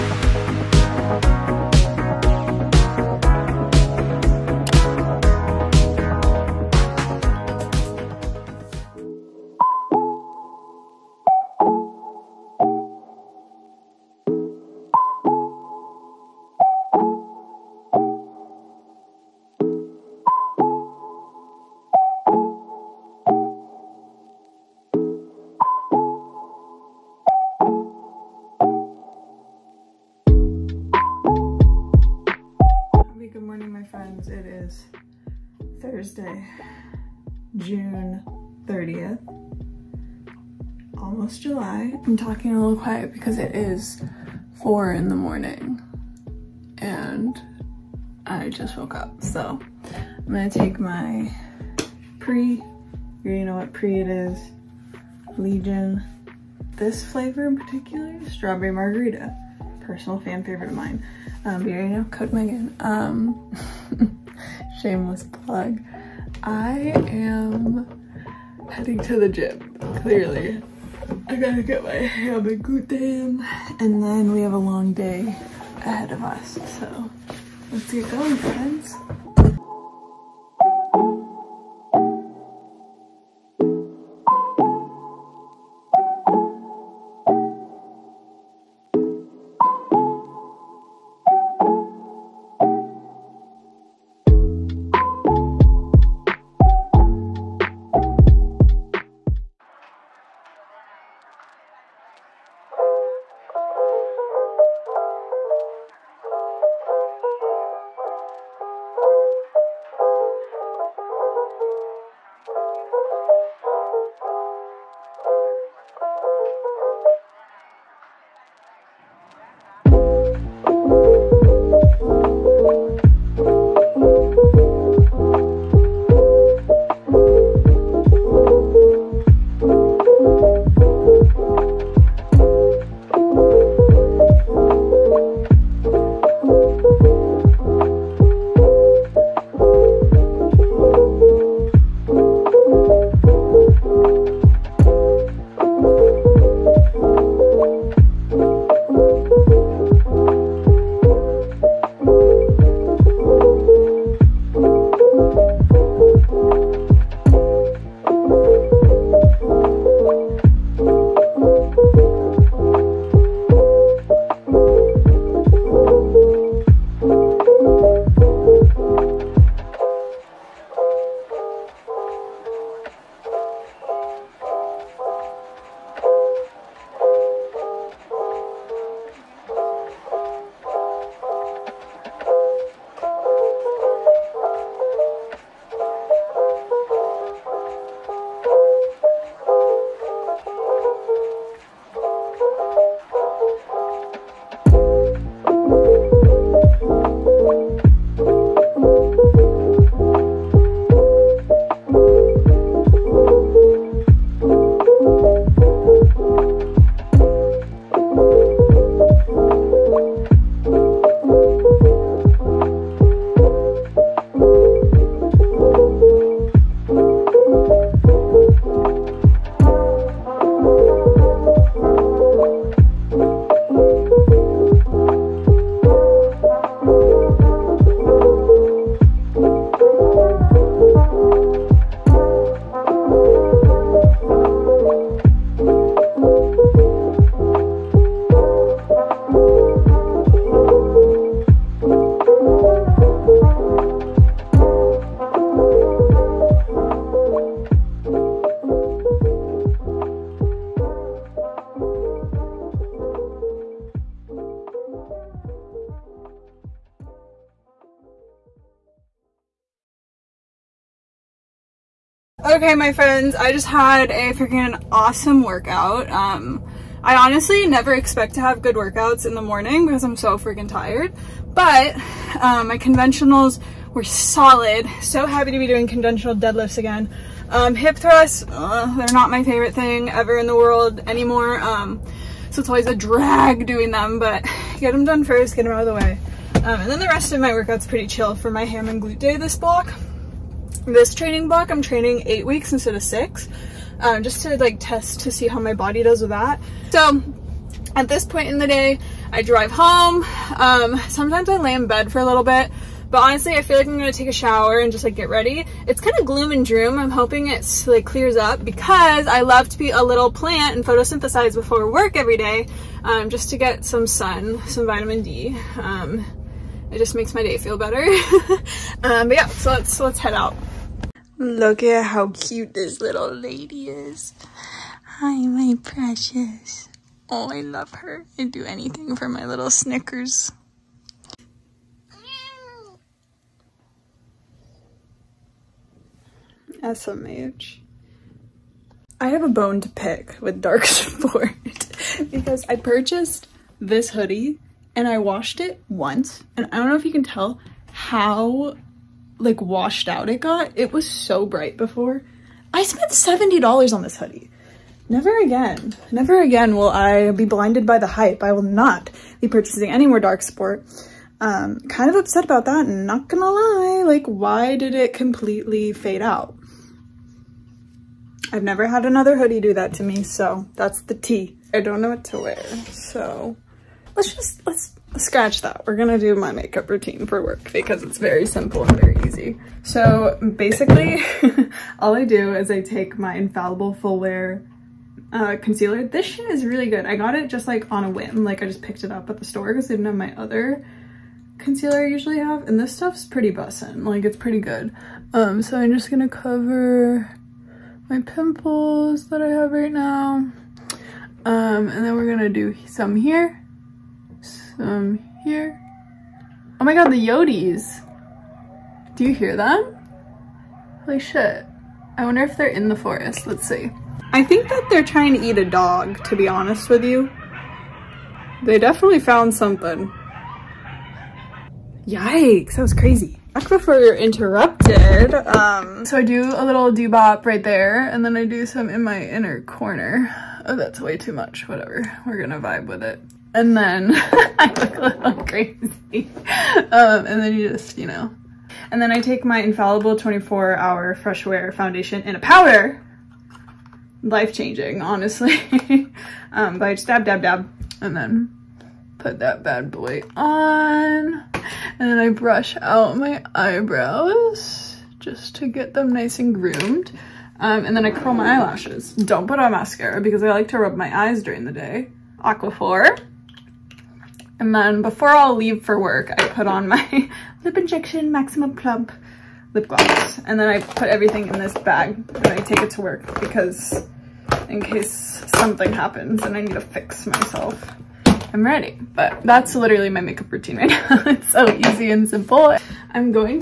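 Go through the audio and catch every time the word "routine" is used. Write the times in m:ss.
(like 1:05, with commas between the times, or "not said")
6:16, 8:00.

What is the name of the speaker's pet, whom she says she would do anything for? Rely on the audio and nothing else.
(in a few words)
Snickers.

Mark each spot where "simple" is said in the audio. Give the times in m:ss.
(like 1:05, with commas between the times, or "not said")
6:18, 8:02.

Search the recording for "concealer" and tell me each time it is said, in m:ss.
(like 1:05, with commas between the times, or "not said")
6:25, 6:31.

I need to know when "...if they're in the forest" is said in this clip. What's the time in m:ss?
6:52.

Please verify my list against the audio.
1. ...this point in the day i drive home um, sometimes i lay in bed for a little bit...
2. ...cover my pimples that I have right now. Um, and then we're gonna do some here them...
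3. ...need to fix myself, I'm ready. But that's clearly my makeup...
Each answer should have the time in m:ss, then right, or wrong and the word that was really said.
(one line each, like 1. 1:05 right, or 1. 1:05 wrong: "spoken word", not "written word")
1. 4:58 right
2. 6:36 right
3. 7:56 wrong: "literally", not "clearly".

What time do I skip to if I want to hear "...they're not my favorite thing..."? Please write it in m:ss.
4:38.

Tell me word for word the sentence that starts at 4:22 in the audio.
Okay, my friends, I just had a freaking awesome workout.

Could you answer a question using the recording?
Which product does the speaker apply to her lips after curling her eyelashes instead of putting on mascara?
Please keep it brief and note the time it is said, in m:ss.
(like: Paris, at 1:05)
Aquaphor, at 7:42.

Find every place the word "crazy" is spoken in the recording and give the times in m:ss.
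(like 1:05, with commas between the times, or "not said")
7:02, 7:15.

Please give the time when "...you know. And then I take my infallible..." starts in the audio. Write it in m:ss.
7:17.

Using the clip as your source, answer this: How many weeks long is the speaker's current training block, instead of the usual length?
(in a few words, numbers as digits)
8.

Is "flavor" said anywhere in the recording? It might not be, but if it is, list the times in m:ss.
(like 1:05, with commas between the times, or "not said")
0:57.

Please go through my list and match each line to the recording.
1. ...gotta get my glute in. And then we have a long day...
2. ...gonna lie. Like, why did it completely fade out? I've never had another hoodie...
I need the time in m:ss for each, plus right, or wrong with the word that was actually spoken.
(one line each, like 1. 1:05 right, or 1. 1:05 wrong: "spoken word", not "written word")
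1. 1:11 wrong: "hamagute", not "glute"
2. 6:03 right.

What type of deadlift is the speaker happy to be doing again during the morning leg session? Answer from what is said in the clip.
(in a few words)
Conventional.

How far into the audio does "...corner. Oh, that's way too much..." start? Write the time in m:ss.
7:09.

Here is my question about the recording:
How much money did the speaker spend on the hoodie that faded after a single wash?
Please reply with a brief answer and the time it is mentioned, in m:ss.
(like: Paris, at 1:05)
$70, at 5:53.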